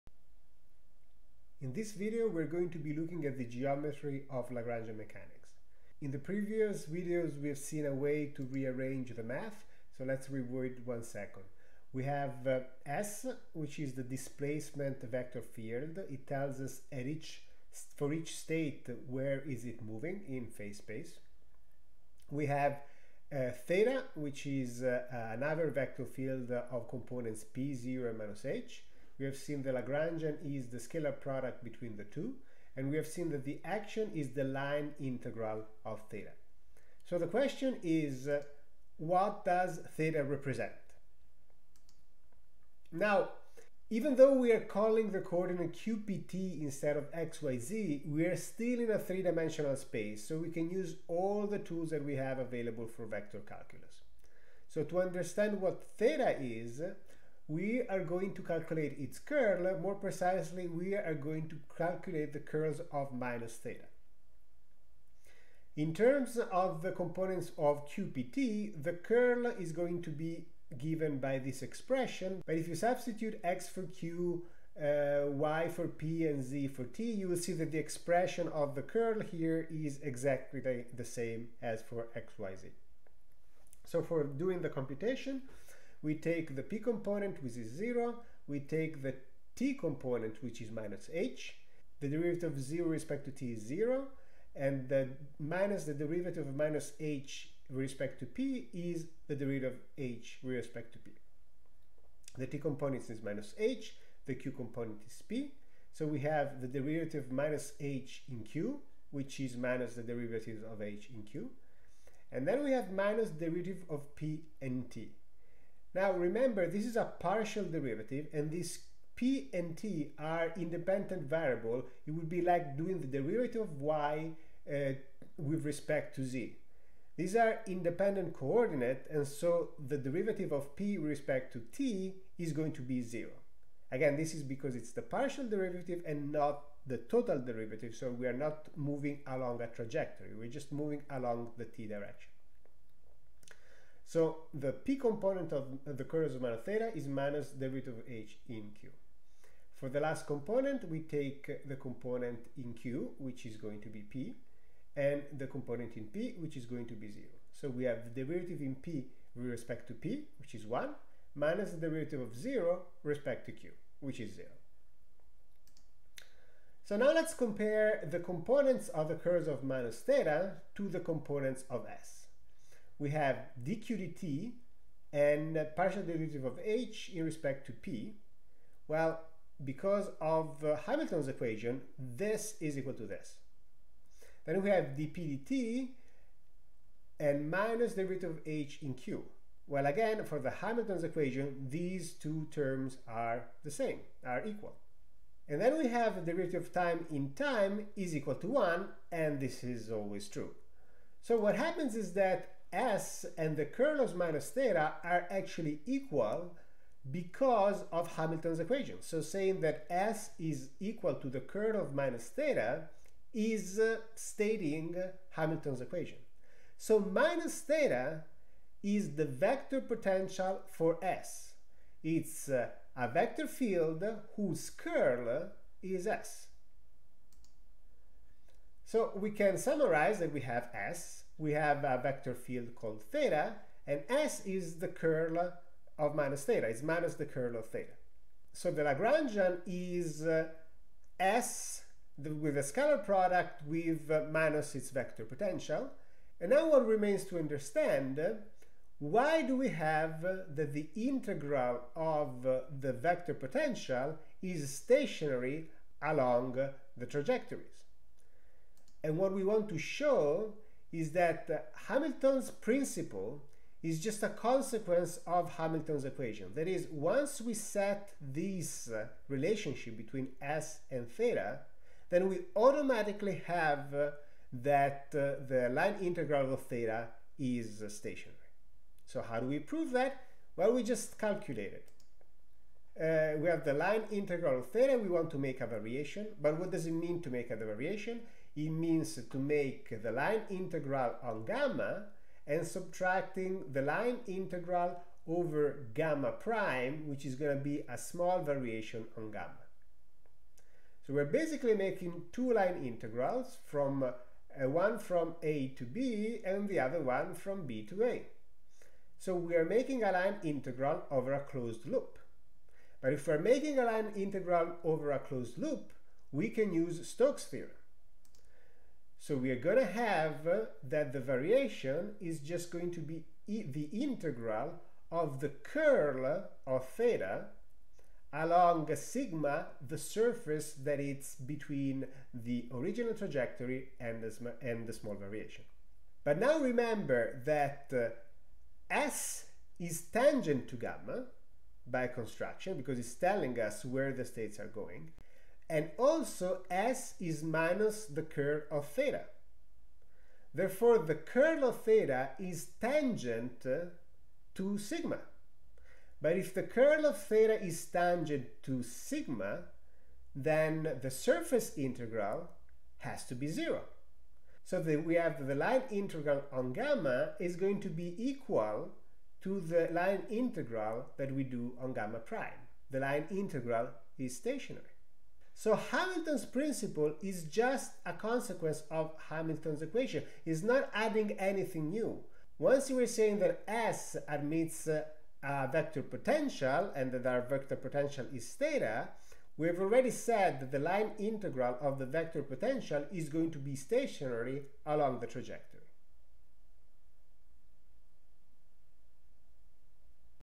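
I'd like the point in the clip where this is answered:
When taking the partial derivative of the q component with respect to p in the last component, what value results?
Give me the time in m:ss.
2:40.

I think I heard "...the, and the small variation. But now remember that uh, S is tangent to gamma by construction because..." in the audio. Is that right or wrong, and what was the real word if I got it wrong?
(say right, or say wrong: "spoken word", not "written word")
right.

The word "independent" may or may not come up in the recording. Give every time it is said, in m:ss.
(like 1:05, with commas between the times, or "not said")
2:00, 2:07.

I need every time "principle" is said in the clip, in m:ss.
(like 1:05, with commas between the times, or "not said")
4:22, 6:16.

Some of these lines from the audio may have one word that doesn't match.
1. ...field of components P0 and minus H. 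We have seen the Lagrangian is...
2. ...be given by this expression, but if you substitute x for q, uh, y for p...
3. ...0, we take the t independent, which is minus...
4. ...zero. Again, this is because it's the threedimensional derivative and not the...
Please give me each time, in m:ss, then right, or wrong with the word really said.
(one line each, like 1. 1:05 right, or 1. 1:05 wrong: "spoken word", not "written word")
1. 0:26 right
2. 1:10 right
3. 1:27 wrong: "component", not "independent"
4. 2:13 wrong: "partial", not "threedimensional".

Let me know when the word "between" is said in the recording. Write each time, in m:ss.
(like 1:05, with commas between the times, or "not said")
0:31, 4:29, 5:31.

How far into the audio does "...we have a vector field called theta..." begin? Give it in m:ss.
3:51.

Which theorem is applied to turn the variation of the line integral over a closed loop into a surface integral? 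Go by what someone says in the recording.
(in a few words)
Stokes theorem.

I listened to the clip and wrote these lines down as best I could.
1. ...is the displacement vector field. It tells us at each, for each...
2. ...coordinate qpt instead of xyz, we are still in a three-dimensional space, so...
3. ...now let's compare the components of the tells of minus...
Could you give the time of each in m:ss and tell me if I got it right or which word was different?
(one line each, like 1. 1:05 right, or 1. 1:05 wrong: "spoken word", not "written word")
1. 0:13 right
2. 0:45 right
3. 2:46 wrong: "curls", not "tells".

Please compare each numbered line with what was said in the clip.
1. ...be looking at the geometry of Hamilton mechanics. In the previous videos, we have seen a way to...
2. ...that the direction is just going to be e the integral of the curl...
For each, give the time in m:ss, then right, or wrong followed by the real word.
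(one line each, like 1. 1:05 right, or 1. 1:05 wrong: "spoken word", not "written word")
1. 0:02 wrong: "Lagrangian", not "Hamilton"
2. 5:20 wrong: "variation", not "direction".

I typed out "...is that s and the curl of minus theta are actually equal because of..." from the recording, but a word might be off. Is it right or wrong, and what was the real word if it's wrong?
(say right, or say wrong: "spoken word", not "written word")
right.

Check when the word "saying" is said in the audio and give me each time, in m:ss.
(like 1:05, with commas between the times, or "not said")
3:29, 6:23.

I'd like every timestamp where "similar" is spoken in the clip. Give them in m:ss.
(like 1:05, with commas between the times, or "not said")
not said.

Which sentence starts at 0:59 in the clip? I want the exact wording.
More precisely, we are going to calculate the curls of minus theta.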